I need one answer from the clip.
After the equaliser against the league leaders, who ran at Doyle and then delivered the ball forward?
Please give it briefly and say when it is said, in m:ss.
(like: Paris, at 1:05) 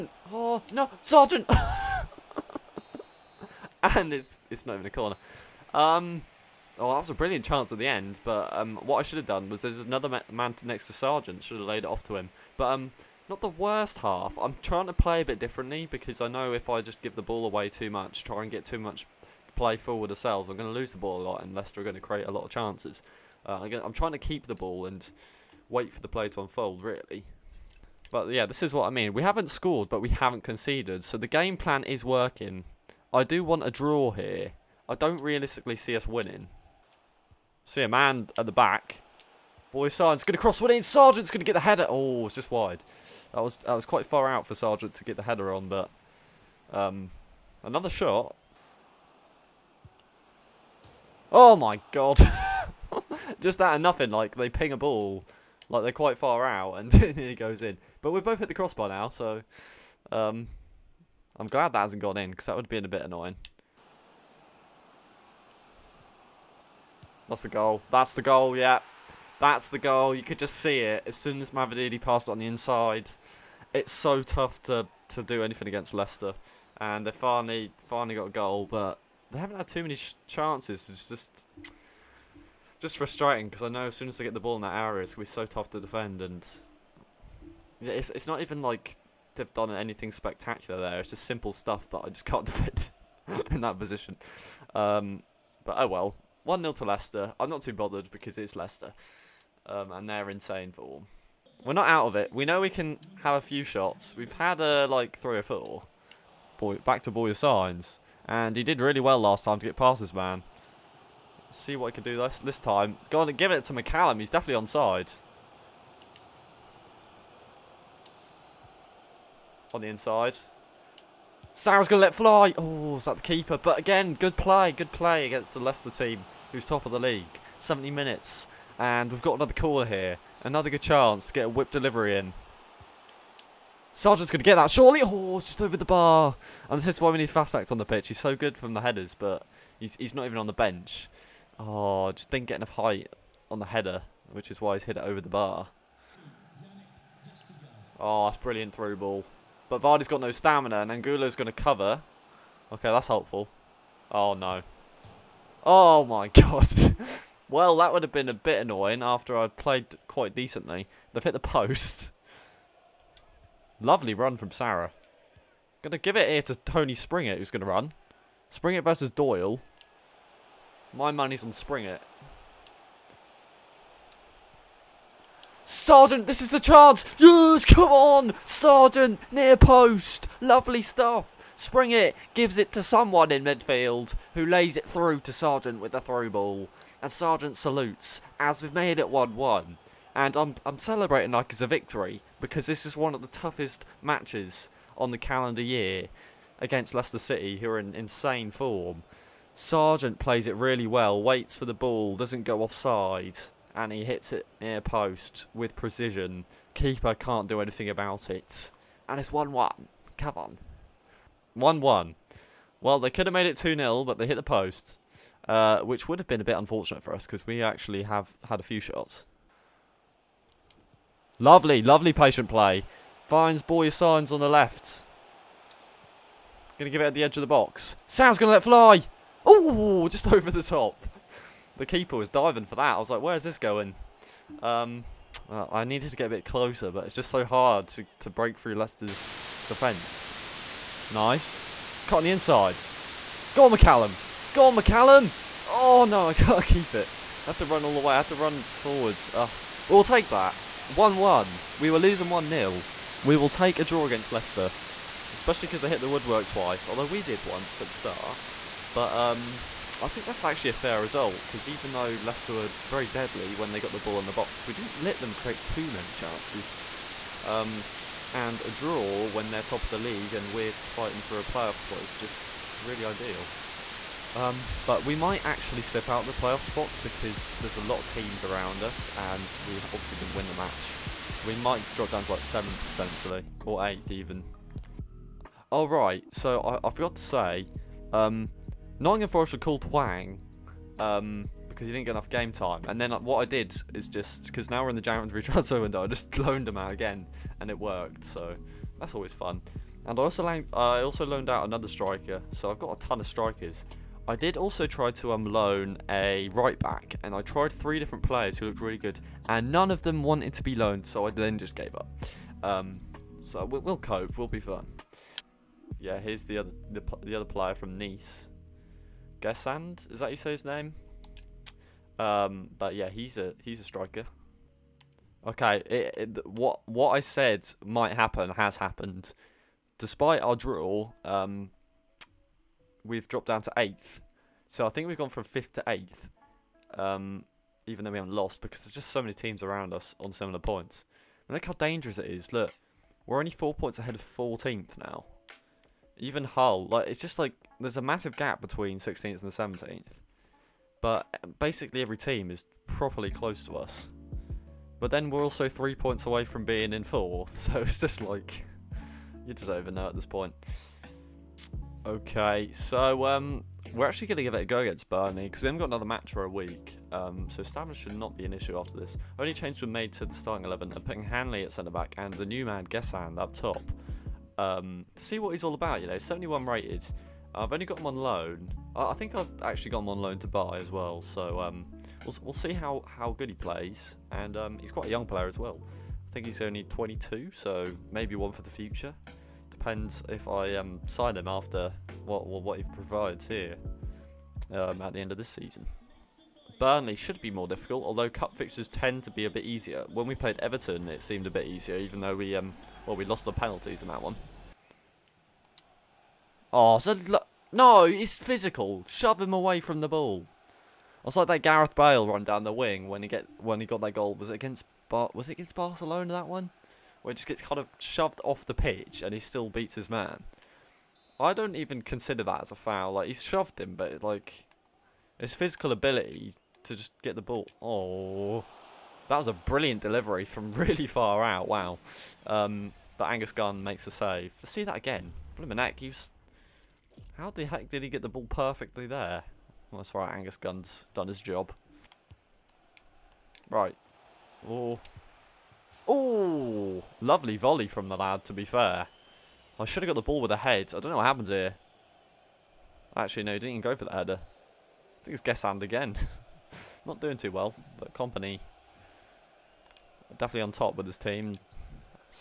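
Tony Springett, at 2:46.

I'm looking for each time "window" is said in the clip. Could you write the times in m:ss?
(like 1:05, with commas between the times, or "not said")
4:55.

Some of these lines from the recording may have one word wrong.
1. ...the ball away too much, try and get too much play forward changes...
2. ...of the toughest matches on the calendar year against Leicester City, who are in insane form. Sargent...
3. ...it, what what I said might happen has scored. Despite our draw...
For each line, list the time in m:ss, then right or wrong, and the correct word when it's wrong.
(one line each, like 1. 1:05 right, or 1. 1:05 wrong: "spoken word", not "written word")
1. 0:17 wrong: "ourselves", not "changes"
2. 3:13 right
3. 5:26 wrong: "happened", not "scored".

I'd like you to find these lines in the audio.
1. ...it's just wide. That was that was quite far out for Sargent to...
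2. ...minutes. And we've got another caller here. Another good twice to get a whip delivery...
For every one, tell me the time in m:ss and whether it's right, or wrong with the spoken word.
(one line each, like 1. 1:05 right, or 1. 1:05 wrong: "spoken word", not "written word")
1. 0:42 right
2. 2:07 wrong: "chance", not "twice".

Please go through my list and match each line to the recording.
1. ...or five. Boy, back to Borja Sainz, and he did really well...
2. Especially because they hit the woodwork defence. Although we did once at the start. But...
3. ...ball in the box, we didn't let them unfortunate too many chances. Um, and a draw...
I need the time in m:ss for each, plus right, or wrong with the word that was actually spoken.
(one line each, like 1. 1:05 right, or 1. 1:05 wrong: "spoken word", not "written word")
1. 1:45 wrong: "four", not "five"
2. 4:15 wrong: "twice", not "defence"
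3. 4:23 wrong: "create", not "unfortunate".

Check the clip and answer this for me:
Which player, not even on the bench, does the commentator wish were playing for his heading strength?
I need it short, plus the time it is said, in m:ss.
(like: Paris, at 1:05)
Fassnacht, at 2:17.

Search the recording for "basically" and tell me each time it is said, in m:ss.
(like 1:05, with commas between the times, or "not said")
5:51.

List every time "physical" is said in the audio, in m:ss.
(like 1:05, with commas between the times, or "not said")
6:48, 7:05.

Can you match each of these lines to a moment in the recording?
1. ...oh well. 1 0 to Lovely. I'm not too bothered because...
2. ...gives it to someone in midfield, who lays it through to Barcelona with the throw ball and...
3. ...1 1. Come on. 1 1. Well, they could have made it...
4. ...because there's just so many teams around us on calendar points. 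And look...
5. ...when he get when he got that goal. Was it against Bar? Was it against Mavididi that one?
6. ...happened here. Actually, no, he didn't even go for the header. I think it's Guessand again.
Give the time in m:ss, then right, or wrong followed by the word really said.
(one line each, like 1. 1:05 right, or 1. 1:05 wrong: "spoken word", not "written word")
1. 1:35 wrong: "Leicester", not "Lovely"
2. 3:02 wrong: "Sargent", not "Barcelona"
3. 3:29 right
4. 5:38 wrong: "similar", not "calendar"
5. 6:53 wrong: "Barcelona", not "Mavididi"
6. 7:31 right.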